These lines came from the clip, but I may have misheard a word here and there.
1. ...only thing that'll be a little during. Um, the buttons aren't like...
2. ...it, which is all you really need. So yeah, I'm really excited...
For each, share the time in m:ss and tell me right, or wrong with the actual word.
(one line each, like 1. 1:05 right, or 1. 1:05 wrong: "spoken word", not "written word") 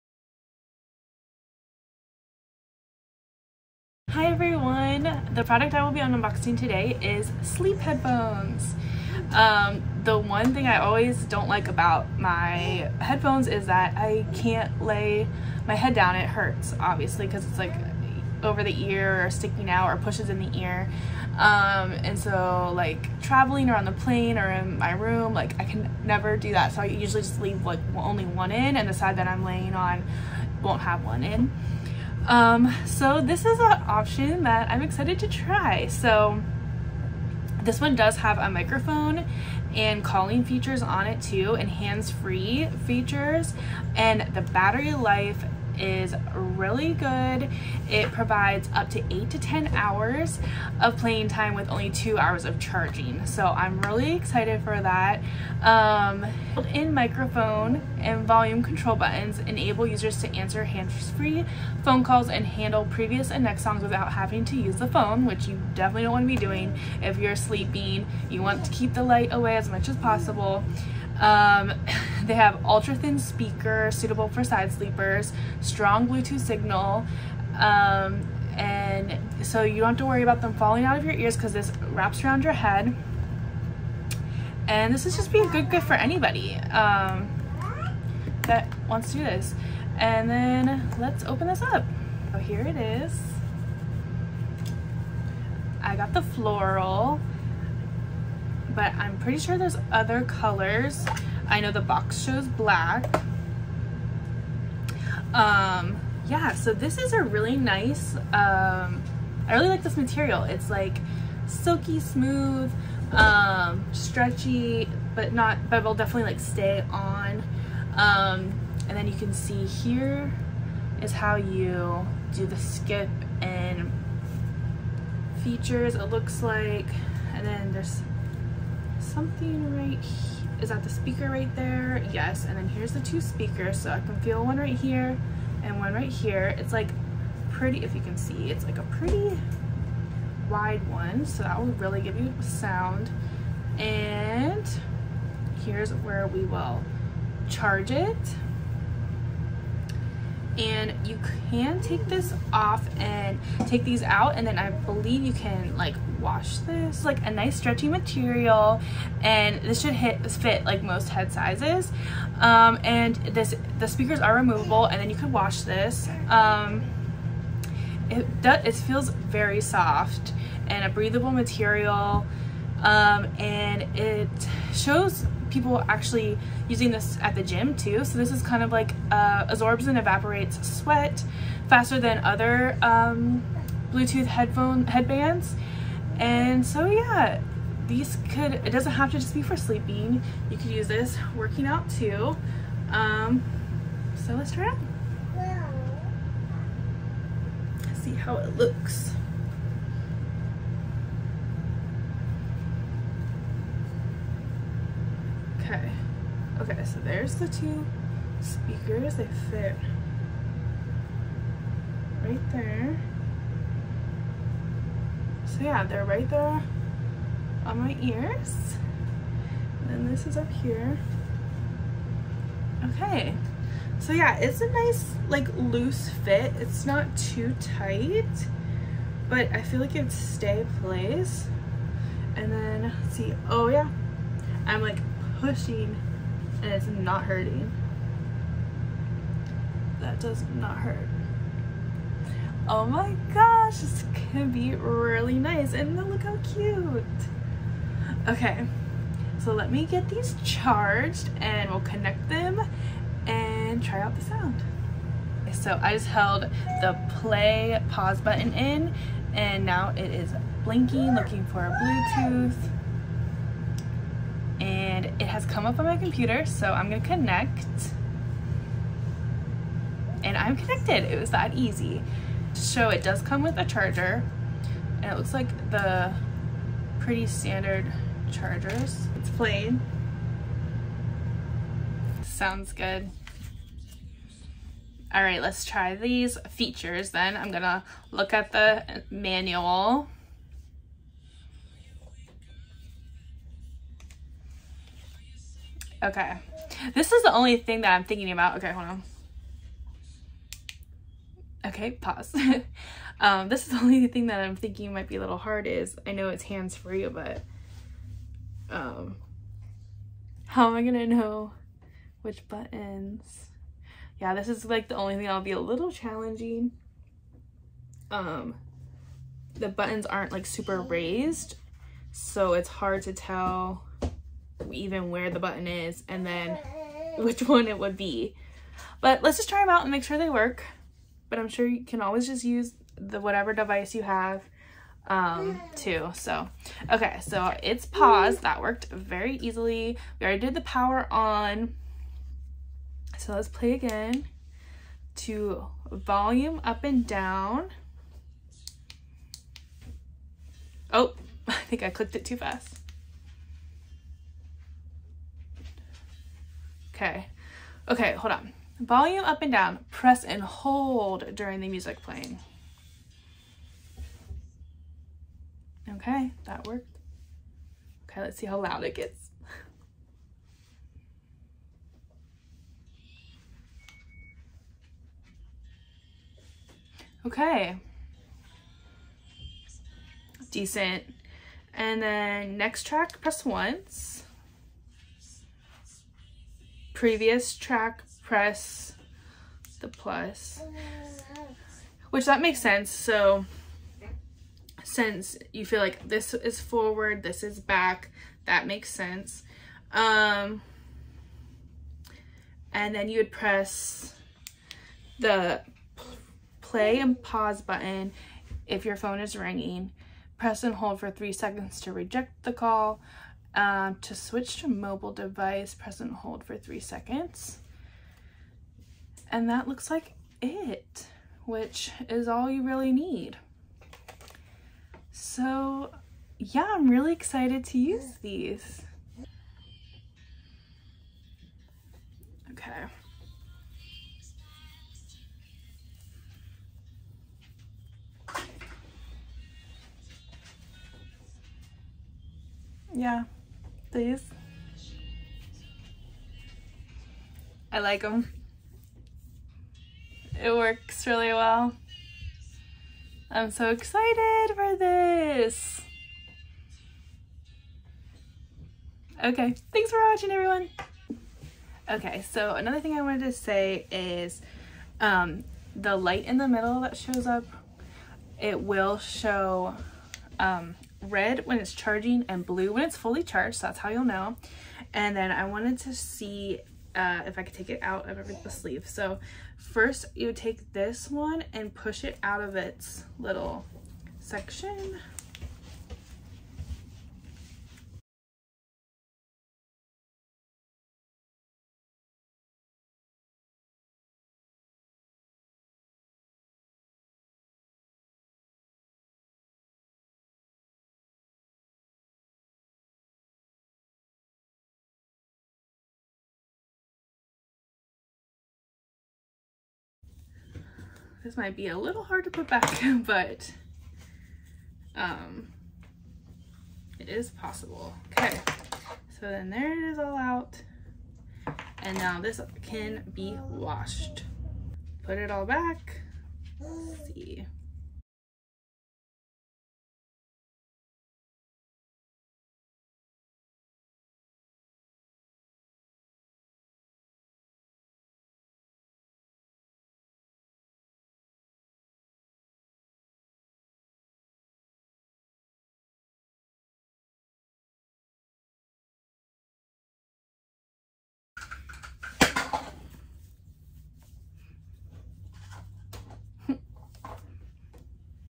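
1. 5:14 wrong: "challenging", not "during"
2. 7:00 right.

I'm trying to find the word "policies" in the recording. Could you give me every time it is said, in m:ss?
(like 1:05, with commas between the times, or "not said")
not said.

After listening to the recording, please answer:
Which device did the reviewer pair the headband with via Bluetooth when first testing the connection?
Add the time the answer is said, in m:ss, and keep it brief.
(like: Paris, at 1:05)
Computer, at 4:25.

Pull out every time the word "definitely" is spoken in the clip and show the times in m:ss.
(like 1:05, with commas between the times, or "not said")
1:05, 1:55.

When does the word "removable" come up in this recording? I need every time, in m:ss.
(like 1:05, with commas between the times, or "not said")
2:44.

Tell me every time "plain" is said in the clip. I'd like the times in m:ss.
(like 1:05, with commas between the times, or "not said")
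4:39.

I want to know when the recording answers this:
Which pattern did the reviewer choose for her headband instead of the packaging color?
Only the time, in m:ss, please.
1:36.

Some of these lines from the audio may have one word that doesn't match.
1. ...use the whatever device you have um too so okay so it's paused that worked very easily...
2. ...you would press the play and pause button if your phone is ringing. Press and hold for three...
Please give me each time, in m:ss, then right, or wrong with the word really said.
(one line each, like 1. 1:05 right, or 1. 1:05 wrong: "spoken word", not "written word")
1. 5:32 right
2. 6:43 right.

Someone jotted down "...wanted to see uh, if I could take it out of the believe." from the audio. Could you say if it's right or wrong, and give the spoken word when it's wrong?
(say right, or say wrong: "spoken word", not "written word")
wrong: "sleeve", not "believe".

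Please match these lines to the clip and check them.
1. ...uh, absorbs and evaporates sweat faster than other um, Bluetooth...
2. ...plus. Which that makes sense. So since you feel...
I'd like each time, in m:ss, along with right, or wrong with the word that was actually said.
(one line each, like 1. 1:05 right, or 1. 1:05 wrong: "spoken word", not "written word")
1. 2:59 right
2. 6:29 right.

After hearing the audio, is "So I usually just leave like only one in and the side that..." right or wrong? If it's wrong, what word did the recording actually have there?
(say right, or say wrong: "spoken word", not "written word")
right.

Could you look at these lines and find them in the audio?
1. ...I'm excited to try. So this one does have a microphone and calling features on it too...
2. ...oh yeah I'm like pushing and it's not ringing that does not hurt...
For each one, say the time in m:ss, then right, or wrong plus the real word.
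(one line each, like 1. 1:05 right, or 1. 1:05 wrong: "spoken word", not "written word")
1. 0:34 right
2. 3:53 wrong: "hurting", not "ringing".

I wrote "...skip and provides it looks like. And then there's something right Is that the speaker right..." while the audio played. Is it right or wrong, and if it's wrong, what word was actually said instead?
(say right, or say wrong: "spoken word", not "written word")
wrong: "features", not "provides".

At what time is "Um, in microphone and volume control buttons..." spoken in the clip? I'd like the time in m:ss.
0:55.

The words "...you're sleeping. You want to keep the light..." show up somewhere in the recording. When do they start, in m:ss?
1:07.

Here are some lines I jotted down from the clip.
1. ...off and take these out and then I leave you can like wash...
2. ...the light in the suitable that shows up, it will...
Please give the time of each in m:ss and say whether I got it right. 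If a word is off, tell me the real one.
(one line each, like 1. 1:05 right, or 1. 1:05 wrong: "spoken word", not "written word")
1. 2:32 wrong: "believe", not "leave"
2. 7:45 wrong: "middle", not "suitable".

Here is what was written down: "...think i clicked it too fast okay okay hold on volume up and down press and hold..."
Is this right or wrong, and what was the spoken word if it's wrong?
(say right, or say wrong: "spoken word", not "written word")
right.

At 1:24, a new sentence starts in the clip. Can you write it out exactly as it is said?
And this is just a good gift for anybody um, that wants to do this.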